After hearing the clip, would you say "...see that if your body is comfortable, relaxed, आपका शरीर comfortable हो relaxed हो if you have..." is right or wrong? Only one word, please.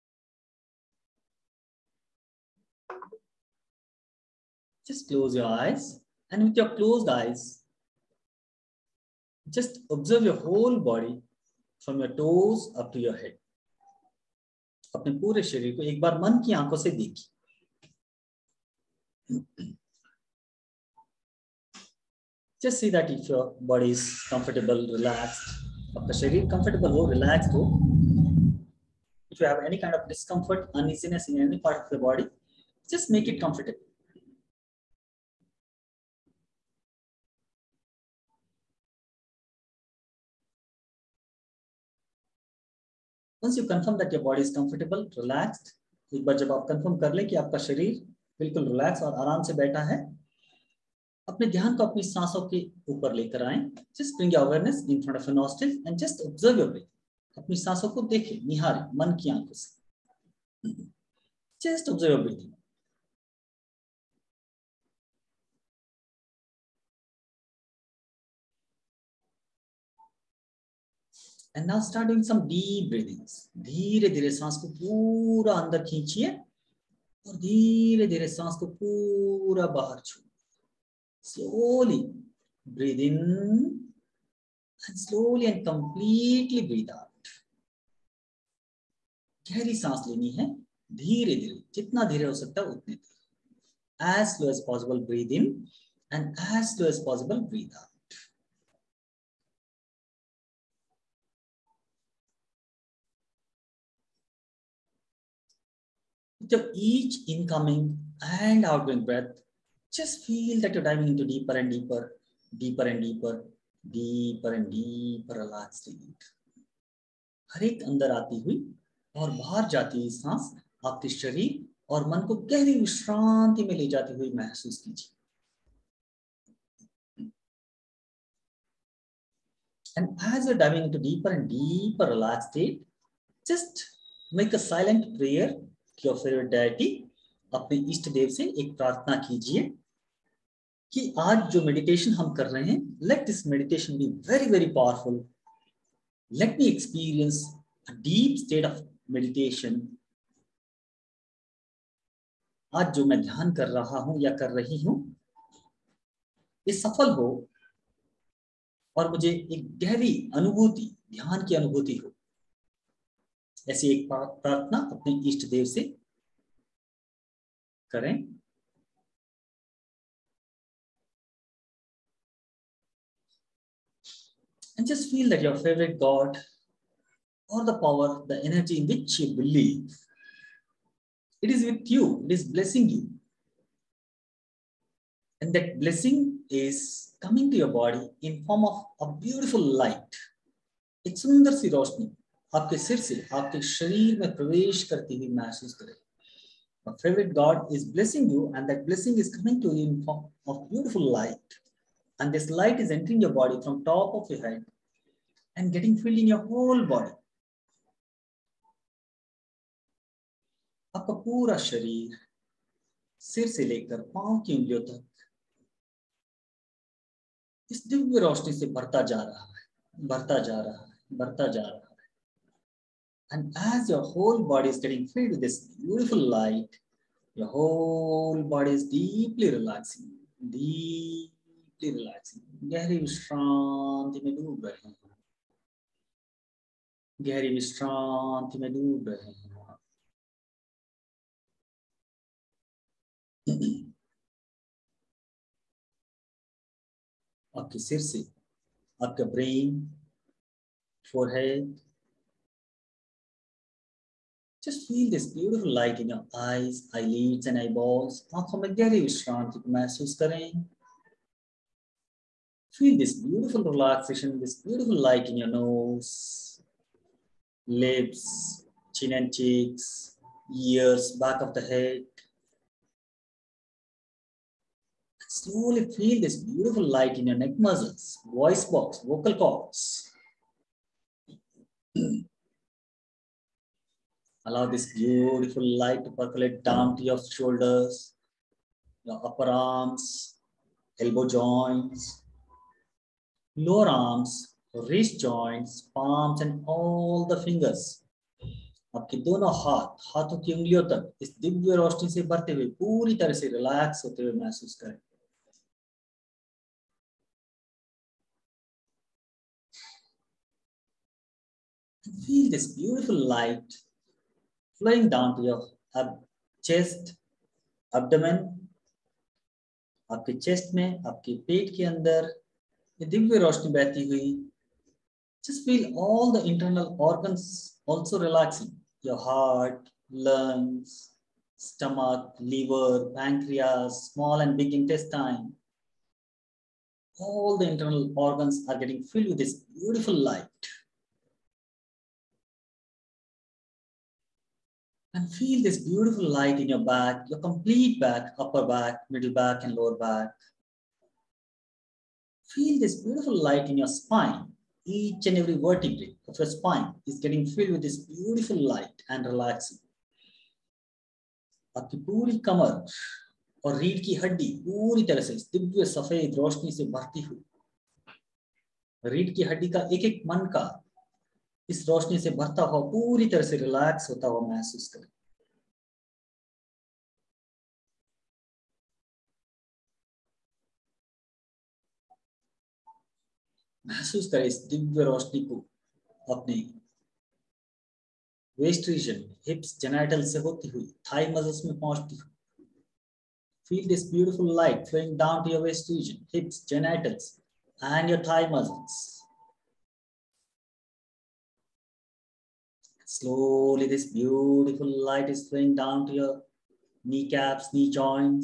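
right.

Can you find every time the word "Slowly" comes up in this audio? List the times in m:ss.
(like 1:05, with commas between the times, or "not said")
4:35, 6:43.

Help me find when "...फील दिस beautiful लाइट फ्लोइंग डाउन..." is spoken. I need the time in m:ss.
6:33.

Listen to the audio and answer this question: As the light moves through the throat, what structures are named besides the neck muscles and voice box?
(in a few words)
Vocal cords.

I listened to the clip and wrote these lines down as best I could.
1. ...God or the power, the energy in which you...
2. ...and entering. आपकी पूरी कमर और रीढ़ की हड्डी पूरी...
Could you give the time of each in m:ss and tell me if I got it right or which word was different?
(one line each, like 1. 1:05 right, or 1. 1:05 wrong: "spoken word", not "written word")
1. 2:56 right
2. 5:59 wrong: "relaxing", not "entering".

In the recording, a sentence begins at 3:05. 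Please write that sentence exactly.
And that blessing is coming to your body in form of a beautiful light.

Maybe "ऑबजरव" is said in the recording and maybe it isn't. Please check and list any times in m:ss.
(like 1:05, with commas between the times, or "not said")
0:56, 1:01.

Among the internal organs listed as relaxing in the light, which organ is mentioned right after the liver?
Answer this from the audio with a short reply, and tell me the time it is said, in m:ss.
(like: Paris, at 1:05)
Pancreas, at 5:33.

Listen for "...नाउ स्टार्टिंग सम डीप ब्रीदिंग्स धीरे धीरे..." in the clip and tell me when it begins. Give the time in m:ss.
1:11.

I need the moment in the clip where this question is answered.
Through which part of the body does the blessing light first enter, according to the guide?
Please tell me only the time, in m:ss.
3:23.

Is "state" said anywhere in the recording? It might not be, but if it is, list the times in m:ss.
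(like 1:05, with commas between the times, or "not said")
1:55, 2:12.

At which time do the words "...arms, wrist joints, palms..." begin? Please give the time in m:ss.
4:53.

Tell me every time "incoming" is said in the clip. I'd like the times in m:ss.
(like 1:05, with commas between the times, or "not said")
1:47.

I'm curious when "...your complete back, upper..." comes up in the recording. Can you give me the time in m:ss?
5:47.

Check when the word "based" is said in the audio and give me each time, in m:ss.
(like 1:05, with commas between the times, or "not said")
not said.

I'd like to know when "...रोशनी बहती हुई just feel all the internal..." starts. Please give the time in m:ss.
5:23.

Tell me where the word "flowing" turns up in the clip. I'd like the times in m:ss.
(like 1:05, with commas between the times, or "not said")
5:14, 6:45.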